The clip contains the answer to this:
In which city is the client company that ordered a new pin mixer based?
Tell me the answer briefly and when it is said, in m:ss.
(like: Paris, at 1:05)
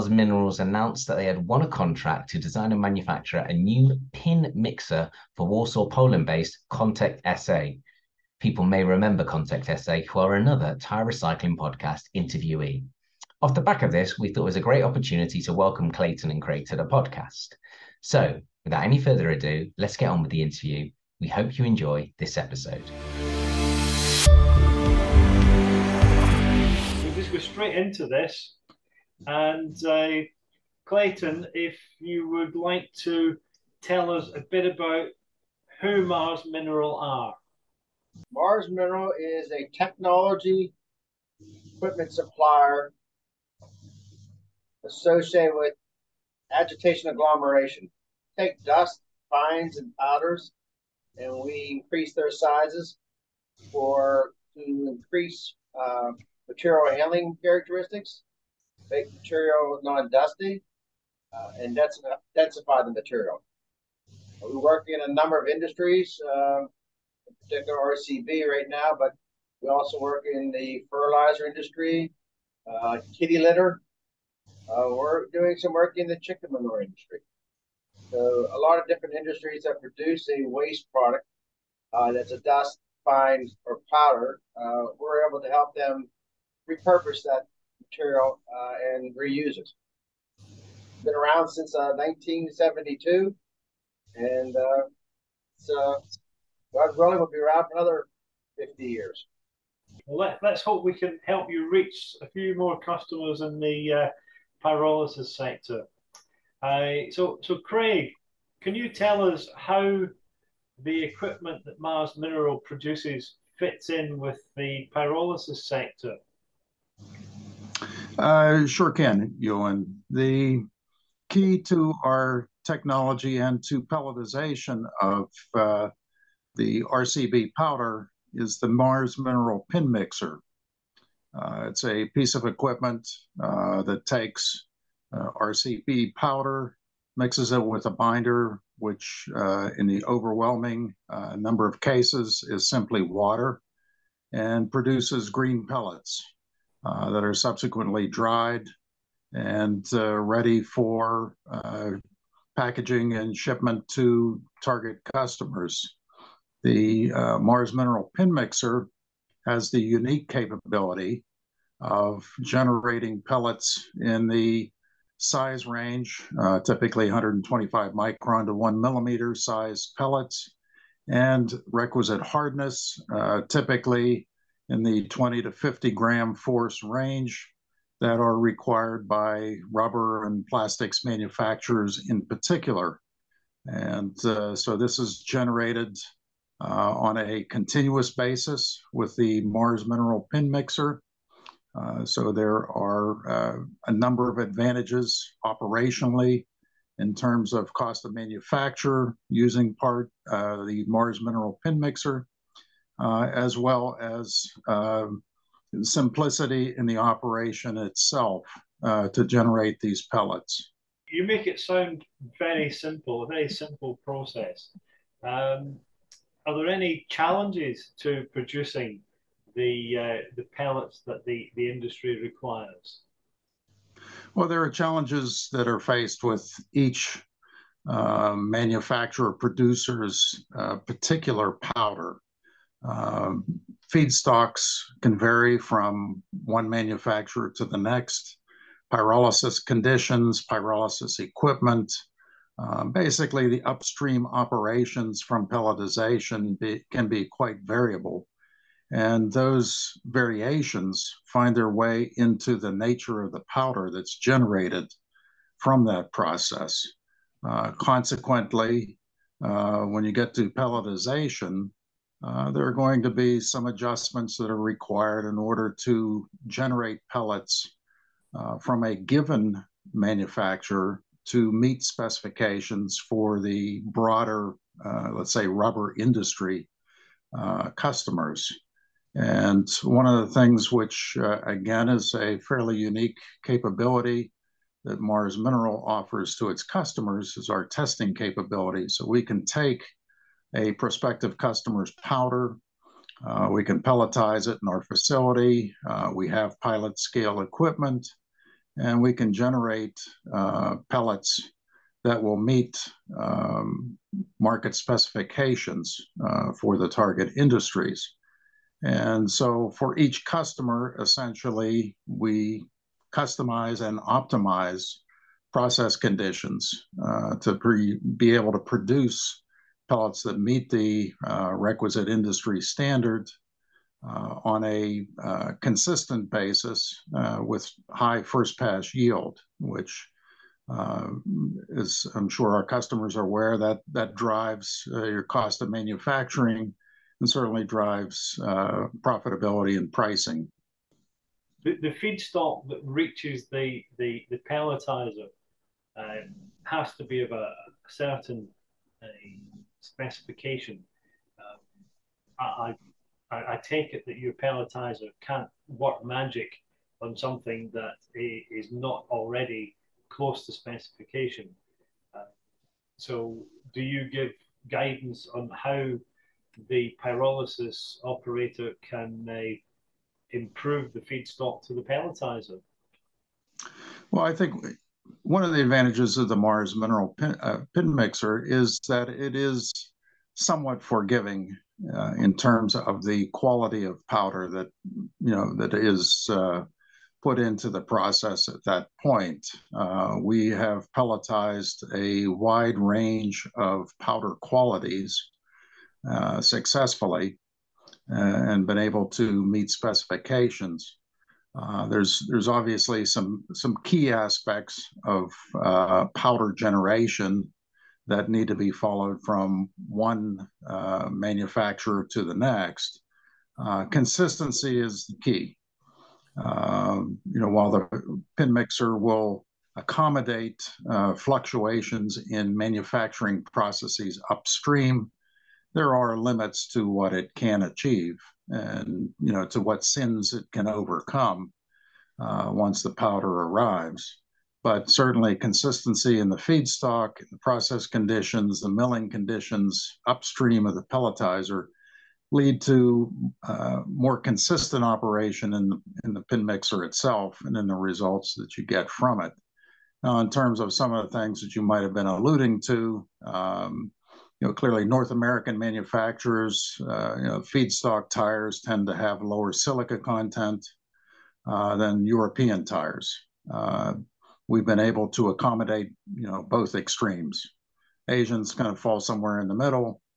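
Warsaw, at 0:05.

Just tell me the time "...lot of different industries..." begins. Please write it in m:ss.
1:18.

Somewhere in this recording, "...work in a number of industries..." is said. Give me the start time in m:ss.
1:04.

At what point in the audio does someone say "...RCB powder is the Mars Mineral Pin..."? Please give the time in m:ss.
2:06.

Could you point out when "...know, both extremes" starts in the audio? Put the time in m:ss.
7:46.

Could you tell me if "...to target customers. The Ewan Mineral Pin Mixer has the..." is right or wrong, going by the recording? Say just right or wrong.
wrong.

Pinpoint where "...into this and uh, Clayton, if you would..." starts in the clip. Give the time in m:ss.
0:27.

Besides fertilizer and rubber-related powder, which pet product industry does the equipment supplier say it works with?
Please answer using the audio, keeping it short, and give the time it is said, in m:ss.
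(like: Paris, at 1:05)
Kitty litter, at 1:13.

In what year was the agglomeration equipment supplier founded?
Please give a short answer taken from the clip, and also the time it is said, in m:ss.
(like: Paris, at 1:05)
1972, at 1:31.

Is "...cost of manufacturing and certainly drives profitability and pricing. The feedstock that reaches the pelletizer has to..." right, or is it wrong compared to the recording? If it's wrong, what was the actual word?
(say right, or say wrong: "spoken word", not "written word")
right.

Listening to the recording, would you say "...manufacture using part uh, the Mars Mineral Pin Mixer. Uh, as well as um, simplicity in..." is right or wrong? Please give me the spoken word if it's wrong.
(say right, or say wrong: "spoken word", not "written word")
right.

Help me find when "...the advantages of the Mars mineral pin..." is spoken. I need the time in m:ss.
6:15.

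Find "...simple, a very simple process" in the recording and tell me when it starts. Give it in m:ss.
3:32.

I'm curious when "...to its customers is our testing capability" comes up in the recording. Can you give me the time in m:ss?
4:46.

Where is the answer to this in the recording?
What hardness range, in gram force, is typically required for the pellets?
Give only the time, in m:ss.
2:55.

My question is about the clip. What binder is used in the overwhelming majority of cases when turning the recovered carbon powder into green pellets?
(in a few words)
Water.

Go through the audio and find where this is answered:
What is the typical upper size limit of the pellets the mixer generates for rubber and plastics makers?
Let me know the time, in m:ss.
2:48.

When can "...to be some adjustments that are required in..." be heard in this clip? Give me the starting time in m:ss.
4:23.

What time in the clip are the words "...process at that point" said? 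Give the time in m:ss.
6:27.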